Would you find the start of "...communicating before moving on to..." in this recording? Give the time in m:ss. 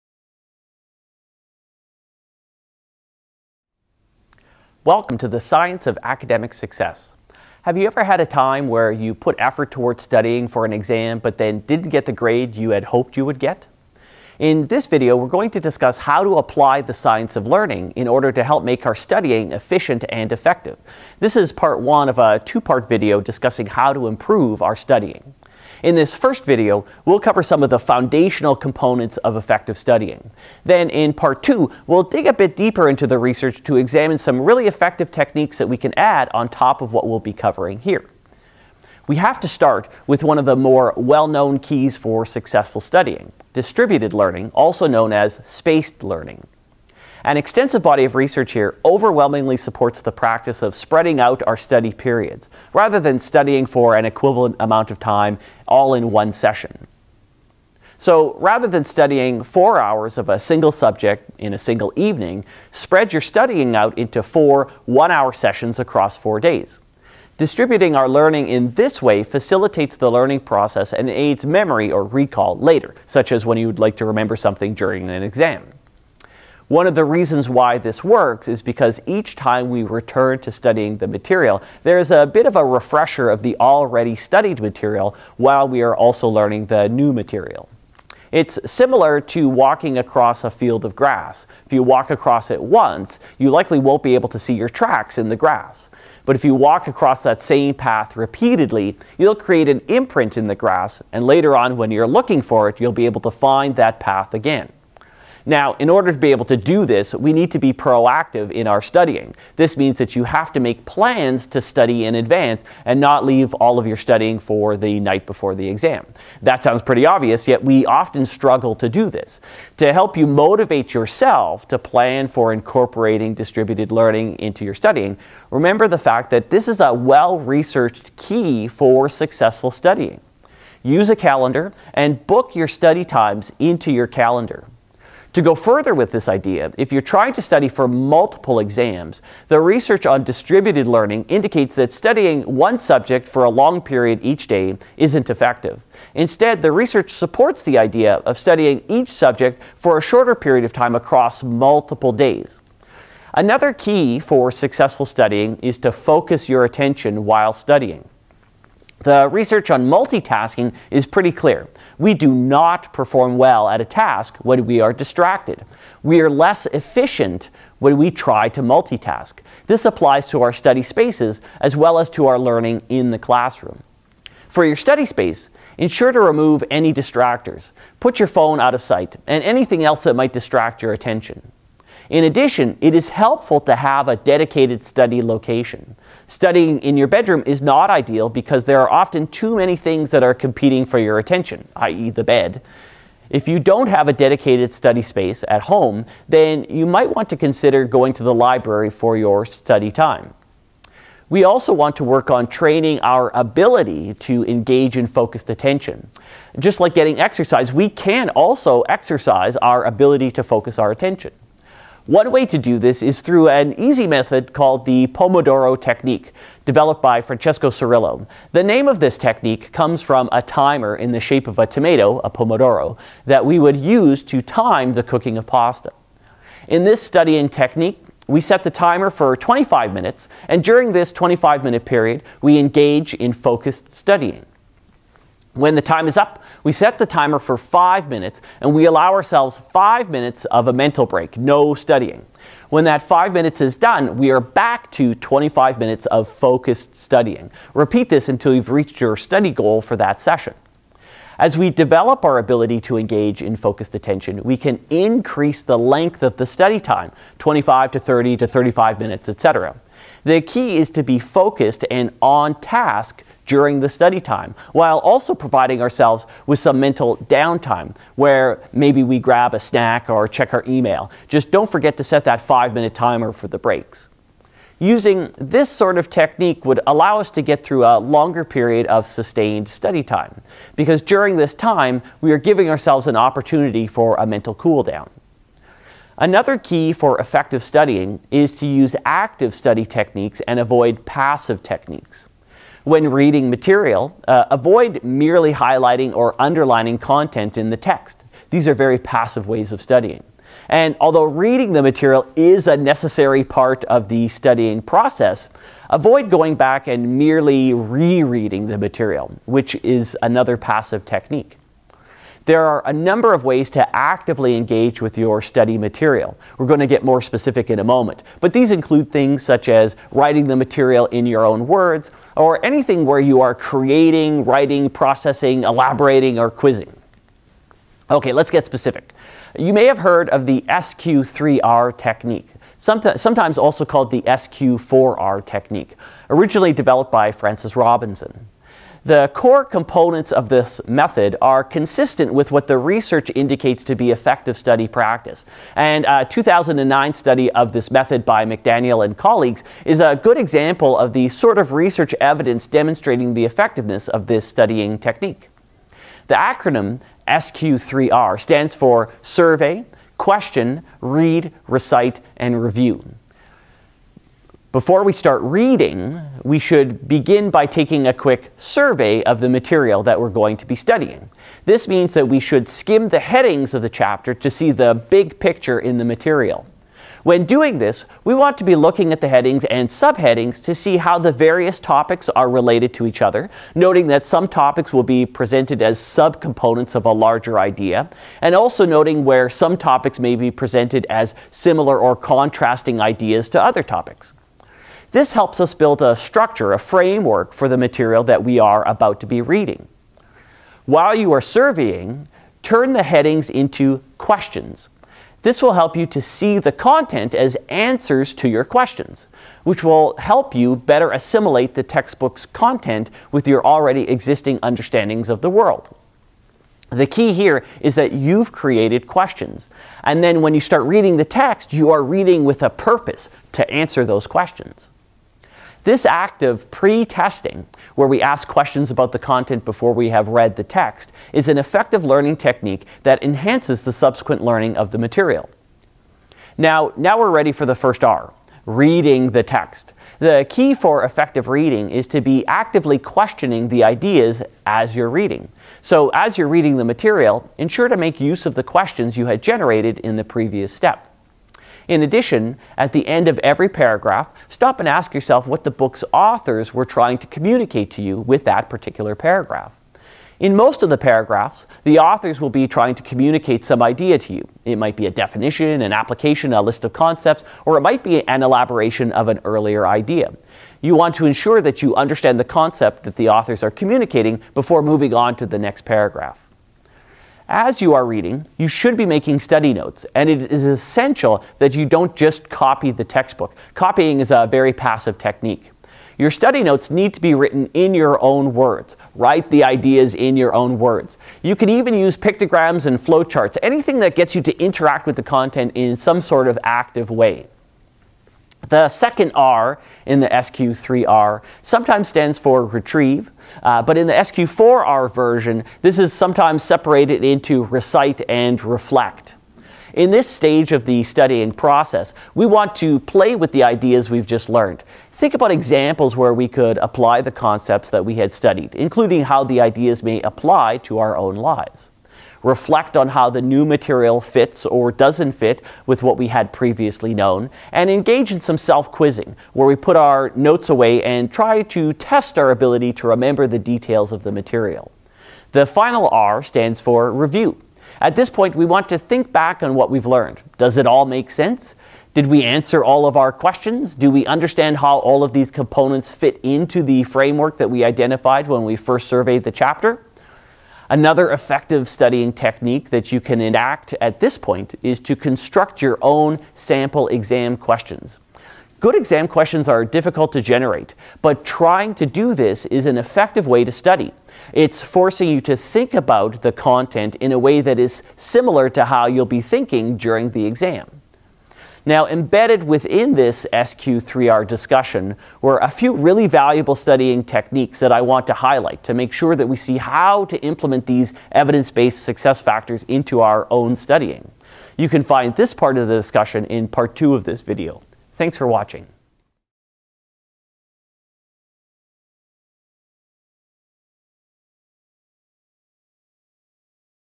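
7:53.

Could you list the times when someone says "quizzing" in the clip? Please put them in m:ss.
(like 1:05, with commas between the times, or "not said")
5:26, 8:48.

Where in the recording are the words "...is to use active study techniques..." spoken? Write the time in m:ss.
4:48.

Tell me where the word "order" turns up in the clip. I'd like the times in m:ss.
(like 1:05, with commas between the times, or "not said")
0:18, 1:45.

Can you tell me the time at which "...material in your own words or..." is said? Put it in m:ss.
5:20.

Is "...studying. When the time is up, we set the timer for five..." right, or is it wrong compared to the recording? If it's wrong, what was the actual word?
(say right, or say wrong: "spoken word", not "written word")
right.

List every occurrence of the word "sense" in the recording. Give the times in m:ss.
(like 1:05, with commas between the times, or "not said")
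9:01.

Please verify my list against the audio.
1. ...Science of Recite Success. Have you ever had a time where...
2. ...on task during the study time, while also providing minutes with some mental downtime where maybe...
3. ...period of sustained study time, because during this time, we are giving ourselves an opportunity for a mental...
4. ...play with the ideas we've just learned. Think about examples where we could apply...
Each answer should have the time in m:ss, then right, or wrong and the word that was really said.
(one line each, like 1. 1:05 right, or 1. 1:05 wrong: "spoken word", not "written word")
1. 0:05 wrong: "Academic", not "Recite"
2. 4:22 wrong: "ourselves", not "minutes"
3. 4:38 right
4. 8:33 right.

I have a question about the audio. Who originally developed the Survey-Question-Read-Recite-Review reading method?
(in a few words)
Francis Robinson.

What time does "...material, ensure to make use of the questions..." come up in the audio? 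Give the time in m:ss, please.
7:26.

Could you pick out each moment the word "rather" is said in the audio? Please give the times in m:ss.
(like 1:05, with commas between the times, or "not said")
0:52, 0:58.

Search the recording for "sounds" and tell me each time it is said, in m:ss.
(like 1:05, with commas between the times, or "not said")
1:56.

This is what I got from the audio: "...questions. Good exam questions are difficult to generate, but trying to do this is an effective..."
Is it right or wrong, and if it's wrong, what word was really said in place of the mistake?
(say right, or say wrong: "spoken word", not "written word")
right.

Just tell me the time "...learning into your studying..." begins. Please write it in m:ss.
2:03.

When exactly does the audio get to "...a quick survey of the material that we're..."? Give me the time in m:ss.
6:08.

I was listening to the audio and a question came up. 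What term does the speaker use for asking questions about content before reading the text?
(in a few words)
pre testing.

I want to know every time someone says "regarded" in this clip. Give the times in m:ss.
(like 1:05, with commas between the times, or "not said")
not said.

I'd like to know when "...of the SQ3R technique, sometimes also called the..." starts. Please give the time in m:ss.
5:30.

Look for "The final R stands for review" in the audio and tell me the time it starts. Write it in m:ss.
8:55.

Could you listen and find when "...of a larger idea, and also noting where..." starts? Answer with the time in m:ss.
6:26.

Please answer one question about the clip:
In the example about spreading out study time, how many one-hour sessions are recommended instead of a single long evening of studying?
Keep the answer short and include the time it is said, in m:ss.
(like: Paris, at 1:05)
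4, at 1:04.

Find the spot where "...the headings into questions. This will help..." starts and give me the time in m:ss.
6:42.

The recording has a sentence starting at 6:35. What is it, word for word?
This helps us build a structure, a framework for the material that we are about to be reading.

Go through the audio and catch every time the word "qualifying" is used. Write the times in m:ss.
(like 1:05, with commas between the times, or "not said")
not said.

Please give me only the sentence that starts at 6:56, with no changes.
The key here is that you've created questions.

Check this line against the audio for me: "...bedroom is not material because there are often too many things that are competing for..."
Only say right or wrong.
wrong.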